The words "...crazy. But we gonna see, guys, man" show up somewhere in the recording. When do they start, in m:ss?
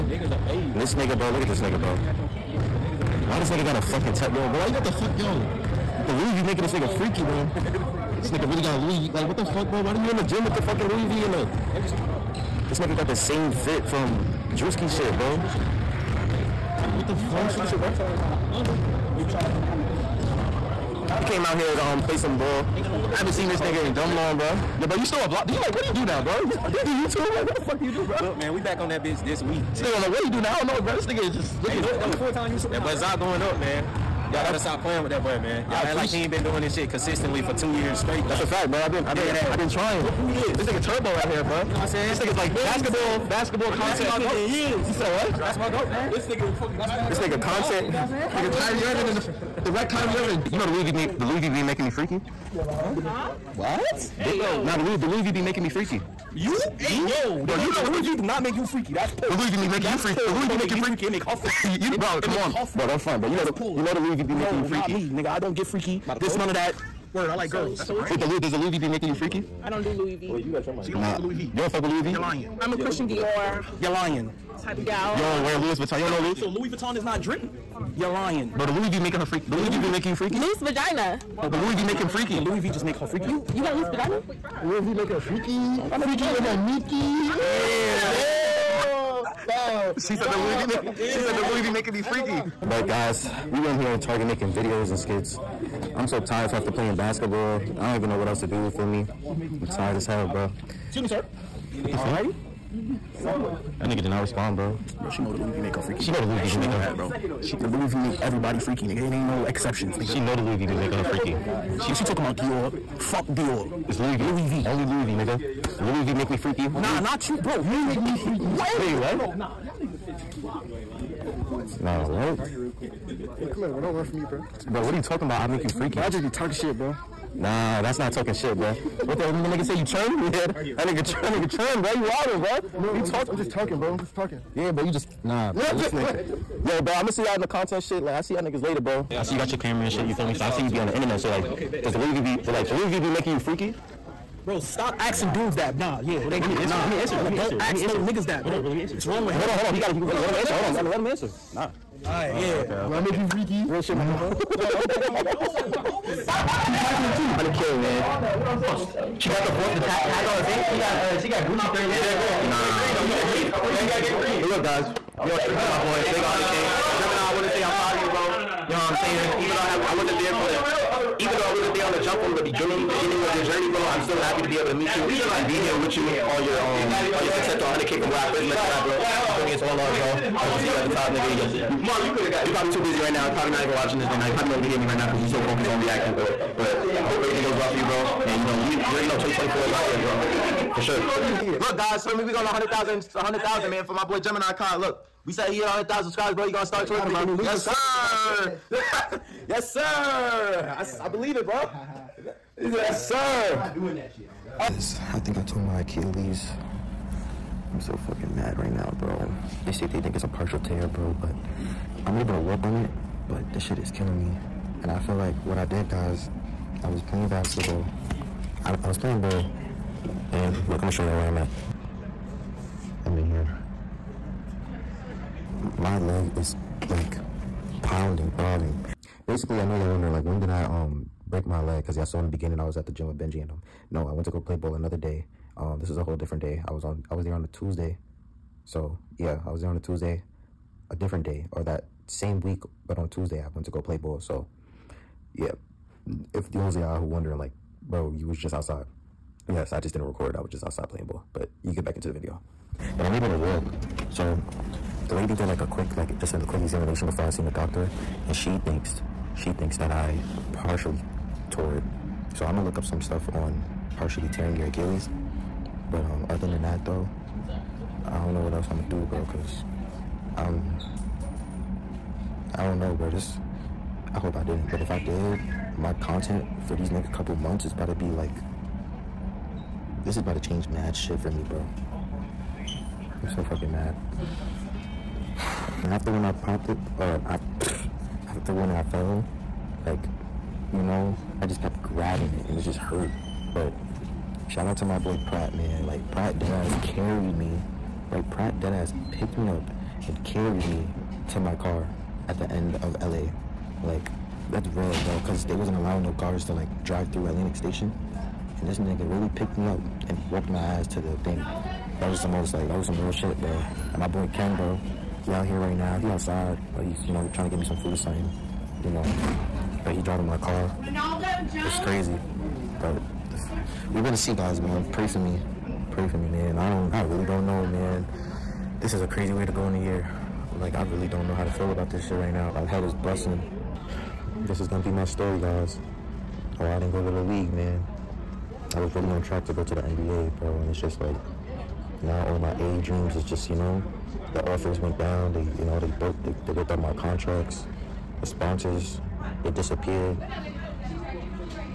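5:21.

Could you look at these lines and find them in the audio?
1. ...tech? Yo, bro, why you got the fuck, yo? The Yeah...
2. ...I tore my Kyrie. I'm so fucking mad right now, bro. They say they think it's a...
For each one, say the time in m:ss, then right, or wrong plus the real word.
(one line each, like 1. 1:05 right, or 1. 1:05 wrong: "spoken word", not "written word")
1. 0:04 wrong: "Louis", not "Yeah"
2. 3:25 wrong: "Achilles", not "Kyrie".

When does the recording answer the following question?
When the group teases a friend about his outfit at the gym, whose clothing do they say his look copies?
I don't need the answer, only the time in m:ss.
0:14.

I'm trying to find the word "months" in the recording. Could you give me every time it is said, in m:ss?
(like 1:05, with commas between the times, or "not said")
4:37.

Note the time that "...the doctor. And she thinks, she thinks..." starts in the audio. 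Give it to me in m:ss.
4:17.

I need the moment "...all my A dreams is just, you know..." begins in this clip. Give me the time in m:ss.
5:42.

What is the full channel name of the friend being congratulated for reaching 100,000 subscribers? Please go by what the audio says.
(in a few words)
Gemini Kai.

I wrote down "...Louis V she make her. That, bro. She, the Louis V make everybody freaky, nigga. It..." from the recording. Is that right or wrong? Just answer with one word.
right.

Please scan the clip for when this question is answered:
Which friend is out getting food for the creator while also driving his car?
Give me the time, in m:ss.
5:14.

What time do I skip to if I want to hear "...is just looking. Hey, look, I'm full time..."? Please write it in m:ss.
0:31.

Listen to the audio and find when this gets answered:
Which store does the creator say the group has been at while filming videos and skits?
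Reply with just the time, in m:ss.
1:34.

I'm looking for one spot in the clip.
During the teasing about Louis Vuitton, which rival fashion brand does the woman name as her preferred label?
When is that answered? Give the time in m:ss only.
1:12.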